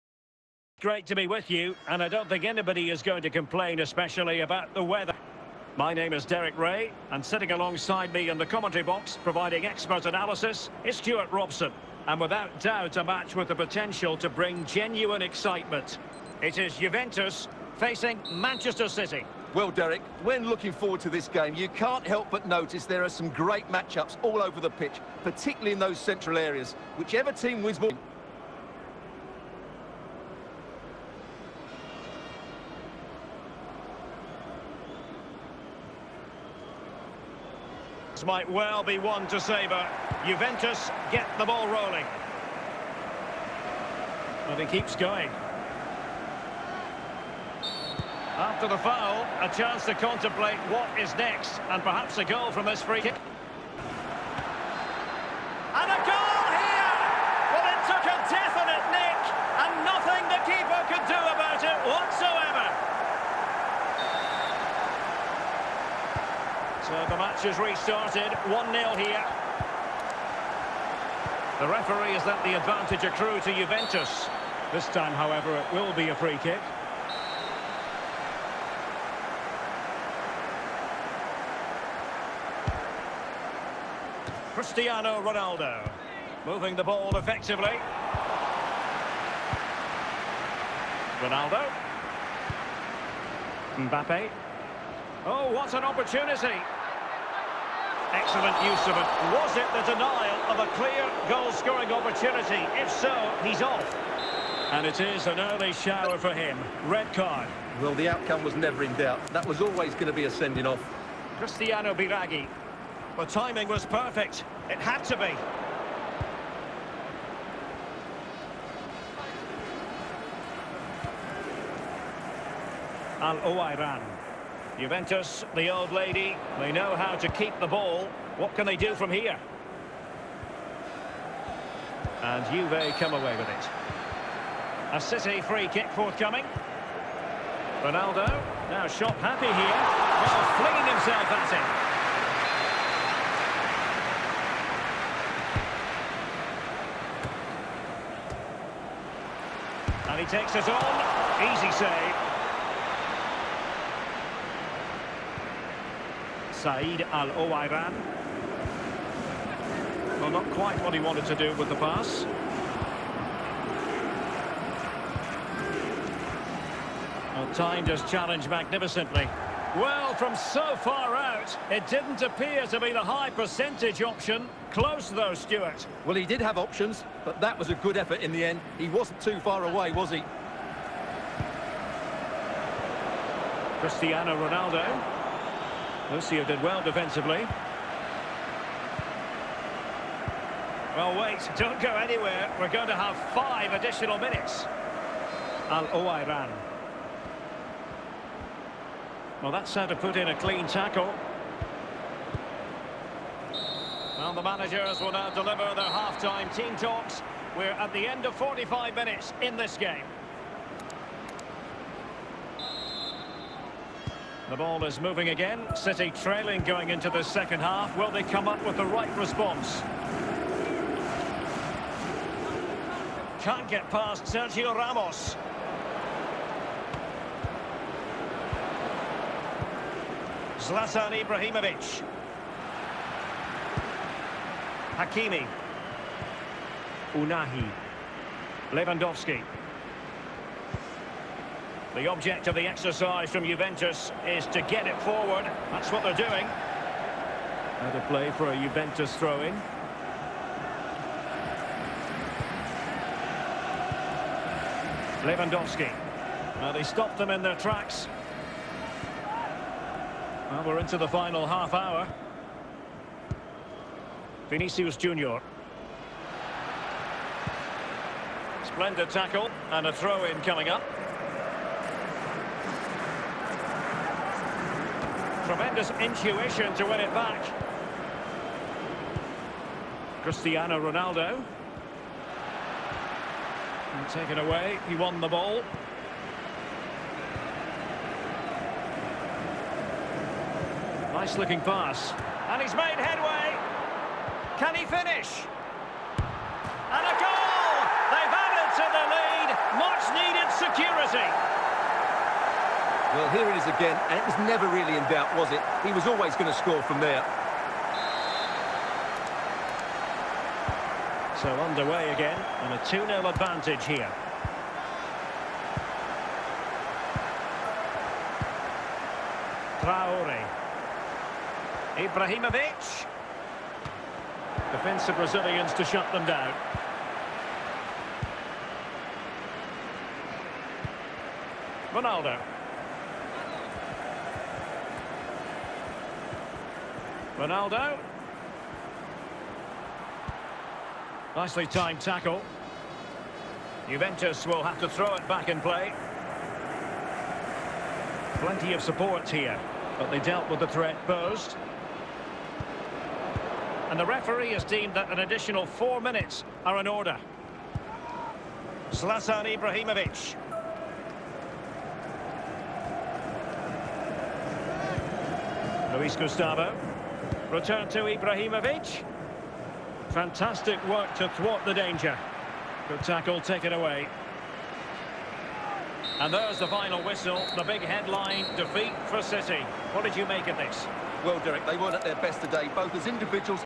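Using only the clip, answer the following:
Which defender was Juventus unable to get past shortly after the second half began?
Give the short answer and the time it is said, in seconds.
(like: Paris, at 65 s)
Sergio Ramos, at 224 s.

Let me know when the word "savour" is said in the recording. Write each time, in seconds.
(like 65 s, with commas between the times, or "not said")
39 s.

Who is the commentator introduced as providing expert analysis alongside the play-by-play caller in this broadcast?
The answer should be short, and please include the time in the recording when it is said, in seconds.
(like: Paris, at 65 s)
Stewart Robson, at 10 s.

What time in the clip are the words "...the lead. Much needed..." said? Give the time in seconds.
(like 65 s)
300 s.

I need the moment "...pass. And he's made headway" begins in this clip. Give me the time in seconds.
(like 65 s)
291 s.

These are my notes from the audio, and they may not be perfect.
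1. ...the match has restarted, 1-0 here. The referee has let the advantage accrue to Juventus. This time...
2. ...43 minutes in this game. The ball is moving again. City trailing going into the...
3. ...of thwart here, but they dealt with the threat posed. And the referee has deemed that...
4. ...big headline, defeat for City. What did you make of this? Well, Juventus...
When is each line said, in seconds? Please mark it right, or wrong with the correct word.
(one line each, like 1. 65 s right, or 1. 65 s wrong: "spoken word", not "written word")
1. 67 s right
2. 208 s wrong: "45", not "43"
3. 348 s wrong: "support", not "thwart"
4. 377 s wrong: "Derek", not "Juventus".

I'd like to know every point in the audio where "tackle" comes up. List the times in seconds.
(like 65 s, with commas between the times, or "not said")
200 s, 269 s, 342 s, 373 s.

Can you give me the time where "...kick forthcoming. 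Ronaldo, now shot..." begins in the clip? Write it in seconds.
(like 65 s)
135 s.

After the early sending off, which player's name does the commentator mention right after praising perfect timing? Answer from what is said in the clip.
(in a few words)
Cristiano Biraghi.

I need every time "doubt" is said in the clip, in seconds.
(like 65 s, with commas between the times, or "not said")
12 s, 108 s, 305 s.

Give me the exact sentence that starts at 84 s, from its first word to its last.
Cristiano Ronaldo moving the ball effectively.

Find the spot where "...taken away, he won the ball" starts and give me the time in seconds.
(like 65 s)
284 s.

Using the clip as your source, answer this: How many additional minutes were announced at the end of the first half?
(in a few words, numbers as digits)
5.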